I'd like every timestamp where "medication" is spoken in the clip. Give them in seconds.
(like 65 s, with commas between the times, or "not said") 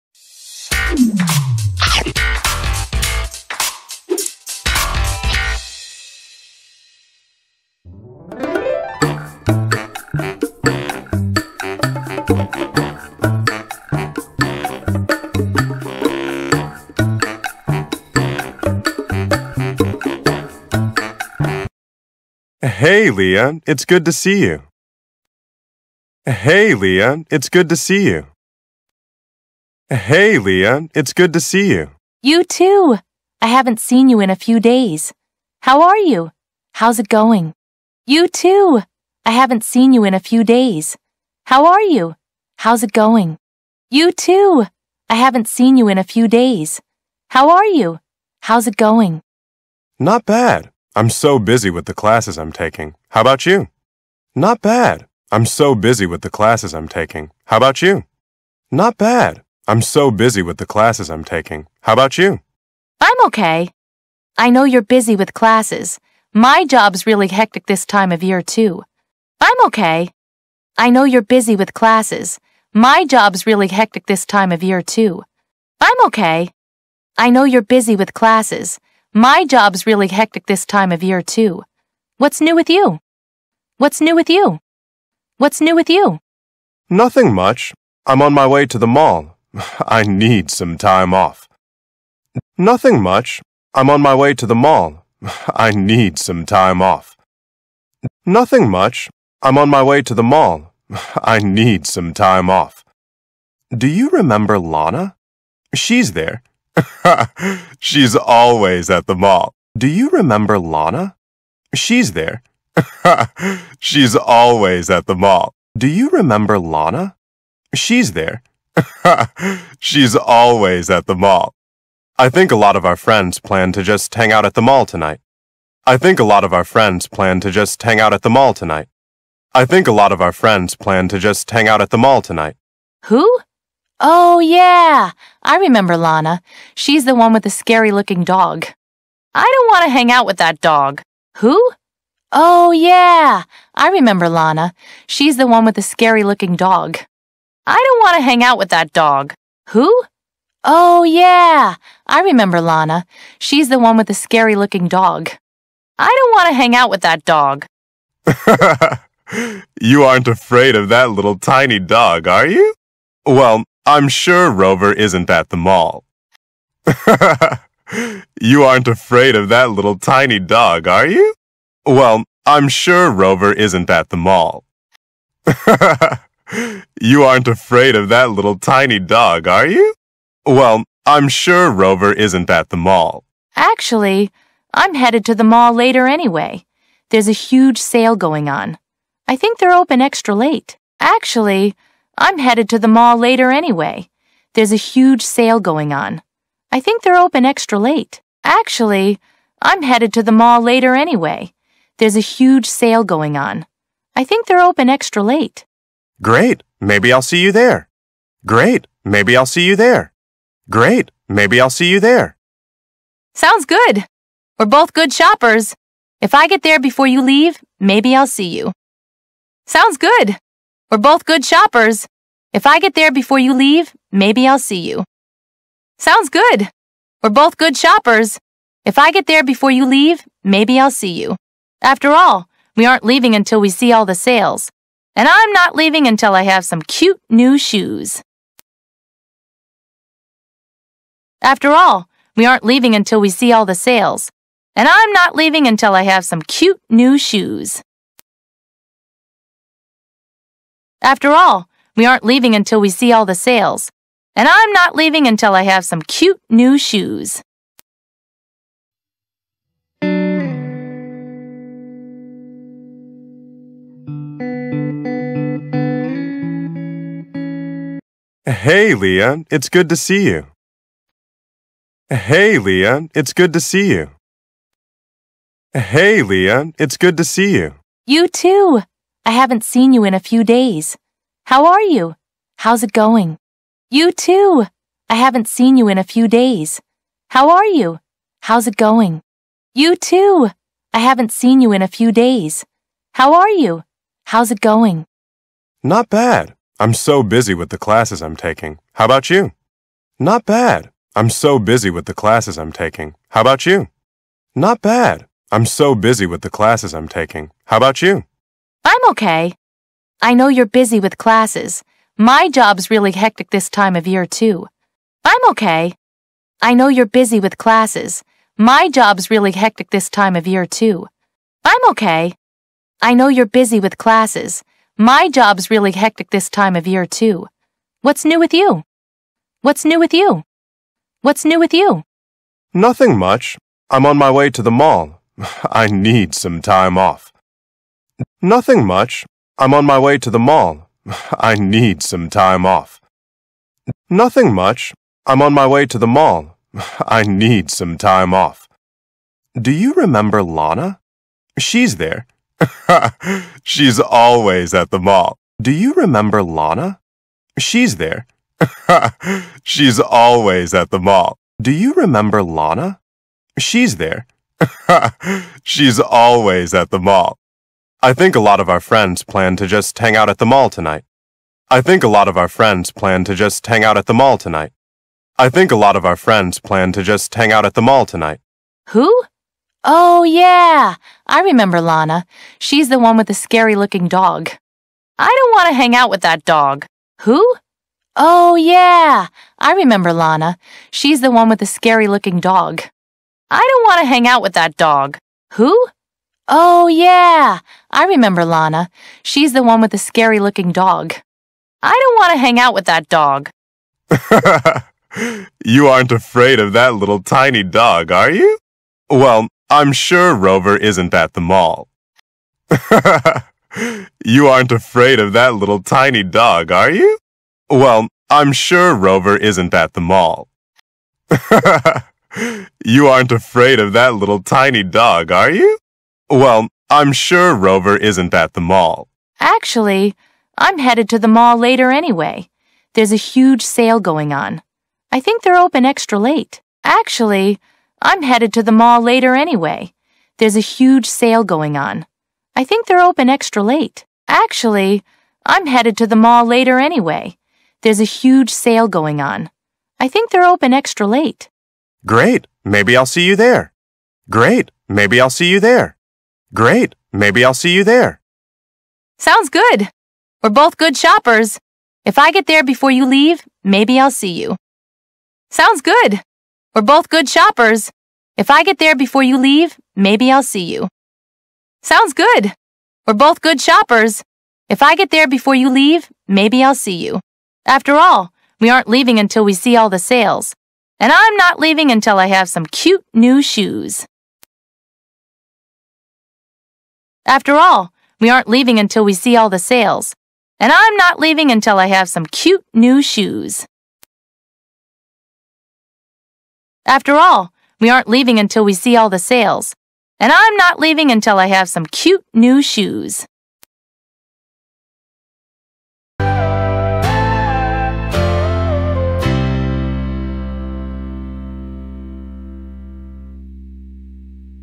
not said.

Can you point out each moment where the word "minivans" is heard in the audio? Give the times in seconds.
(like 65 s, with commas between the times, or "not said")
not said.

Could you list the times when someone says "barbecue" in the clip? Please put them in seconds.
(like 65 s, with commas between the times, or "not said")
not said.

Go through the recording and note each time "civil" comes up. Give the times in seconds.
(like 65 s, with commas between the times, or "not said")
not said.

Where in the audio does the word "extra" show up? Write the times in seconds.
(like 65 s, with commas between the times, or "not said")
190 s, 197 s, 204 s, 435 s, 443 s, 450 s.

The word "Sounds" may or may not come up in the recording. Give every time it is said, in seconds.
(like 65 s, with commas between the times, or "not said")
213 s, 219 s, 225 s, 459 s, 465 s, 471 s.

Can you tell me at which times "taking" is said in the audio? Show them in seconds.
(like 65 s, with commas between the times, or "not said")
52 s, 56 s, 61 s, 298 s, 302 s, 307 s.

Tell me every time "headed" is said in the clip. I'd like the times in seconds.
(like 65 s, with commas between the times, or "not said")
184 s, 192 s, 199 s, 430 s, 438 s, 445 s.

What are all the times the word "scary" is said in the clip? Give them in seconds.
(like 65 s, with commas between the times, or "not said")
137 s, 145 s, 154 s, 383 s, 391 s, 399 s.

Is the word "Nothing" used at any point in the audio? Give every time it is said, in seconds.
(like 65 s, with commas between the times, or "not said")
86 s, 92 s, 98 s, 332 s, 338 s, 344 s.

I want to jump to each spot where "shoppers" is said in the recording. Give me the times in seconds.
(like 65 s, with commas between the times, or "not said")
215 s, 221 s, 227 s, 460 s, 467 s, 473 s.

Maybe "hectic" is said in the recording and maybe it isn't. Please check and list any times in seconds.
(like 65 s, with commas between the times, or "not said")
67 s, 73 s, 80 s, 313 s, 319 s, 325 s.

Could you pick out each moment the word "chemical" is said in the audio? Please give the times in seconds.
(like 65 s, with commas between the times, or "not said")
not said.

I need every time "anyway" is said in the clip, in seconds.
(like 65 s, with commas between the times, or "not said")
186 s, 193 s, 200 s, 431 s, 439 s, 446 s.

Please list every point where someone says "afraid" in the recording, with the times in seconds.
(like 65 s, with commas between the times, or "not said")
160 s, 168 s, 177 s, 406 s, 414 s, 423 s.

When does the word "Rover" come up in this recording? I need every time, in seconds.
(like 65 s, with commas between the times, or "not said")
164 s, 173 s, 181 s, 410 s, 418 s, 427 s.